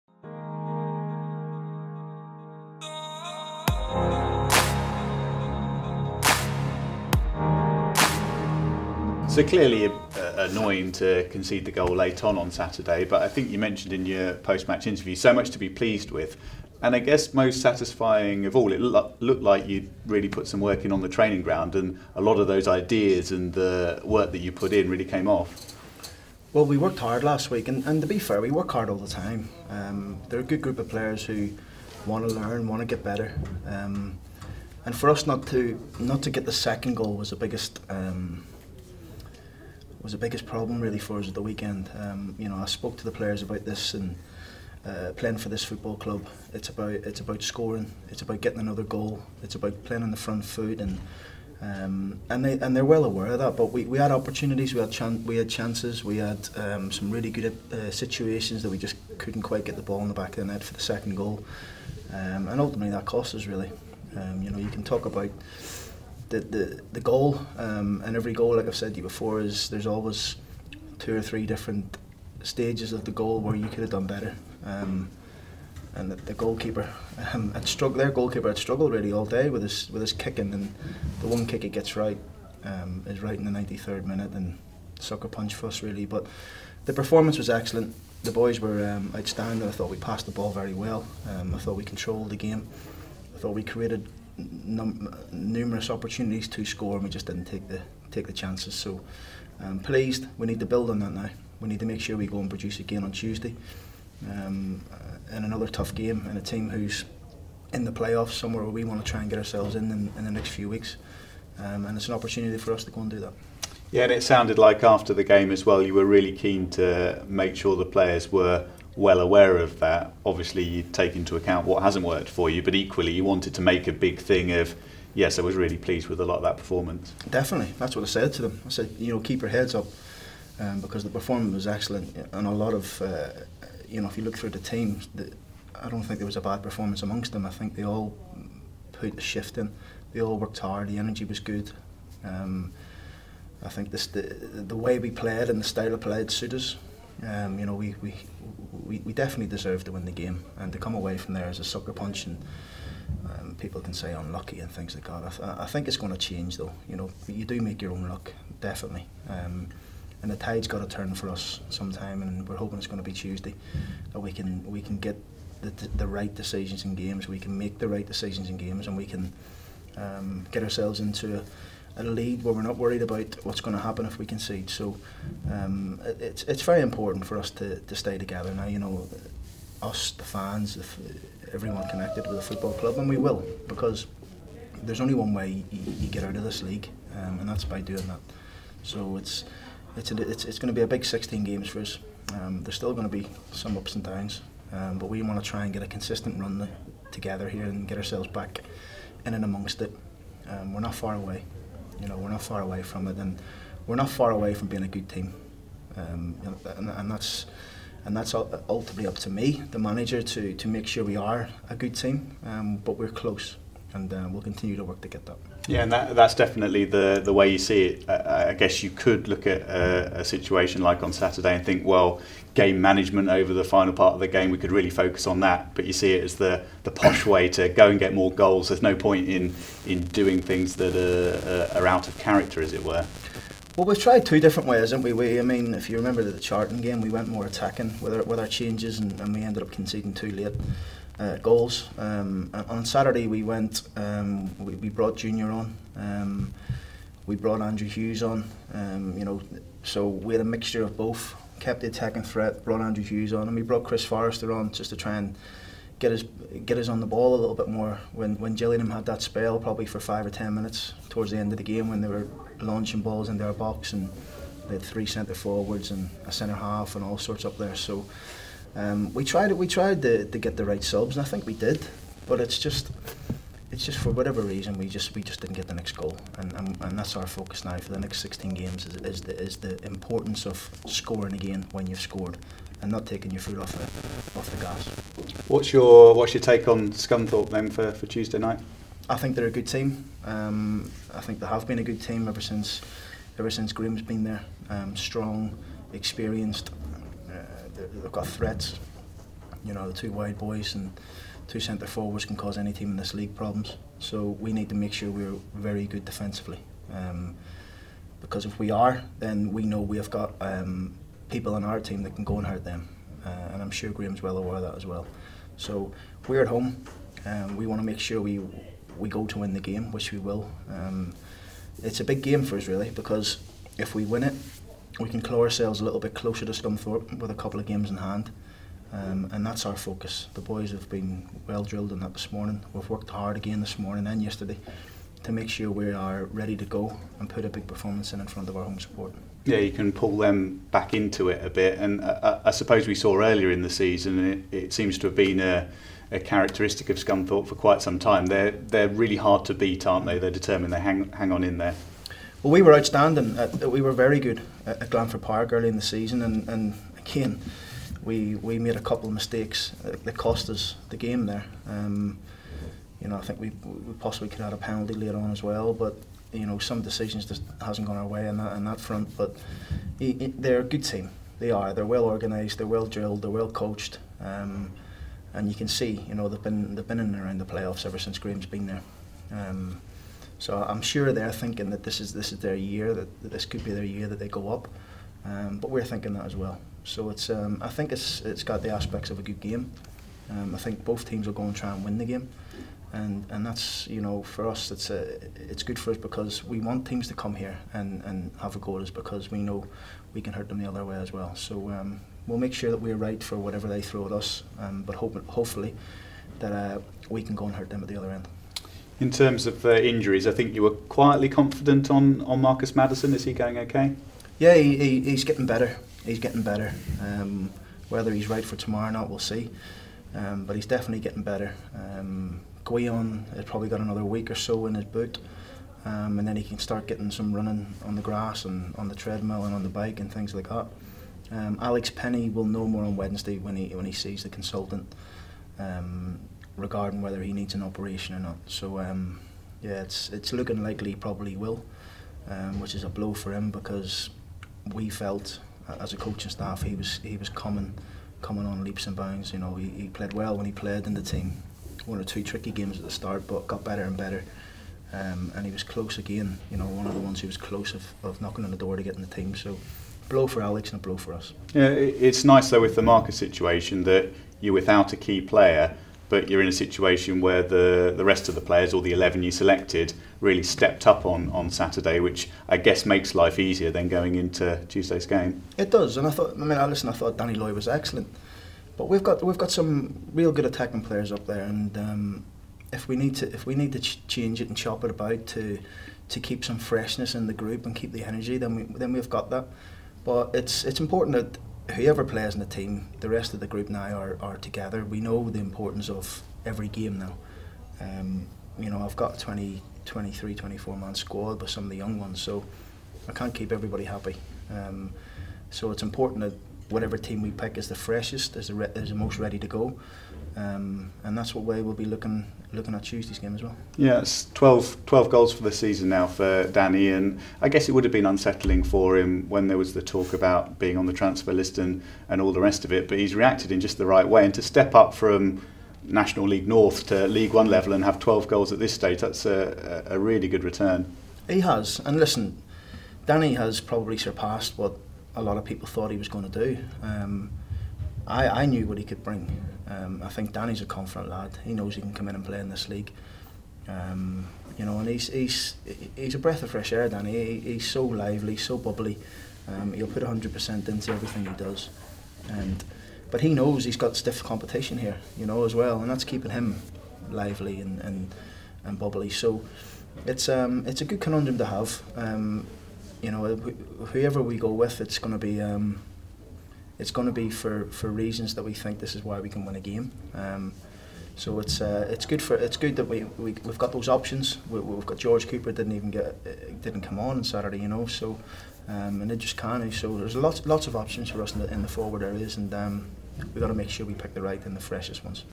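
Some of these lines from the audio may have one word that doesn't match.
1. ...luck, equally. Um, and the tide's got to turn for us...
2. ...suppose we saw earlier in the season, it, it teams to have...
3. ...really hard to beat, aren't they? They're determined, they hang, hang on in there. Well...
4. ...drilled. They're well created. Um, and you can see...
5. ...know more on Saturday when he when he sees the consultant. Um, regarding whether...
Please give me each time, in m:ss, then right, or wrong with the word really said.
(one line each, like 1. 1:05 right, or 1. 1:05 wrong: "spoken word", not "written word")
1. 2:38 wrong: "definitely", not "equally"
2. 5:42 wrong: "seems", not "teams"
3. 5:48 right
4. 6:12 wrong: "coached", not "created"
5. 7:12 wrong: "Wednesday", not "Saturday".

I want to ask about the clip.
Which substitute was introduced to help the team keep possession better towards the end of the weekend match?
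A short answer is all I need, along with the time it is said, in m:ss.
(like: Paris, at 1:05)
Chris Forrester, at 4:13.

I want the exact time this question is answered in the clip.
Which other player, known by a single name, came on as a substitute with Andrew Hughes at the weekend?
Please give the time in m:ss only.
4:05.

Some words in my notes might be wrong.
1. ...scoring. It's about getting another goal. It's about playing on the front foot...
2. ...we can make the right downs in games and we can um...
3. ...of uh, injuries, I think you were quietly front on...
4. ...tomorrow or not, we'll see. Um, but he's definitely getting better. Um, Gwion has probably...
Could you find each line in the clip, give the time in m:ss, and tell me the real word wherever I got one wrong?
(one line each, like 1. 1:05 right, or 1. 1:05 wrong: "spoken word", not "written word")
1. 0:47 right
2. 2:47 wrong: "decisions", not "downs"
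3. 6:49 wrong: "confident", not "front"
4. 6:58 right.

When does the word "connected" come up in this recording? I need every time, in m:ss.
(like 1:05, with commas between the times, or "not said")
3:01.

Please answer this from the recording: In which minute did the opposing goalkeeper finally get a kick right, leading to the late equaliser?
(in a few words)
93rd.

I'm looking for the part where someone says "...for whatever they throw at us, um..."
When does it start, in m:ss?
6:43.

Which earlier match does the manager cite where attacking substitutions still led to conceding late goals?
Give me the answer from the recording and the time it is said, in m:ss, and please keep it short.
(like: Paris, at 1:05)
Charlton, at 3:56.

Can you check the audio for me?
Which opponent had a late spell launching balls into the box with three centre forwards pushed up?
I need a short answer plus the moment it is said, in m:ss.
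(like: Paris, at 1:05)
Gillingham, at 4:18.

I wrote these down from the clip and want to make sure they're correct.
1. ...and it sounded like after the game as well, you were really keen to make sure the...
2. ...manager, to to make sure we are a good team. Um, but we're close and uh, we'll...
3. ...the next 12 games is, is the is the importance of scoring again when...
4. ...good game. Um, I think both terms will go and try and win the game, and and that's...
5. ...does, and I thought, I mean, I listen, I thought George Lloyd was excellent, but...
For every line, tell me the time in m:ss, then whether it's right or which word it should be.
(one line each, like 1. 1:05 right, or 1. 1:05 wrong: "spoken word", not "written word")
1. 1:54 right
2. 3:29 right
3. 4:37 wrong: "16", not "12"
4. 6:29 wrong: "teams", not "terms"
5. 7:55 wrong: "Danny", not "George".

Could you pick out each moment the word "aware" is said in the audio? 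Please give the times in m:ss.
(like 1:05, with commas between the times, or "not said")
0:53, 1:59, 5:14.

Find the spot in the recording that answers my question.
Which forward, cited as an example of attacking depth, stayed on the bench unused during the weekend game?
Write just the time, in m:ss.
9:34.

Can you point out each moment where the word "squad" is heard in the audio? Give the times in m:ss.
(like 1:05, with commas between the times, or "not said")
8:20.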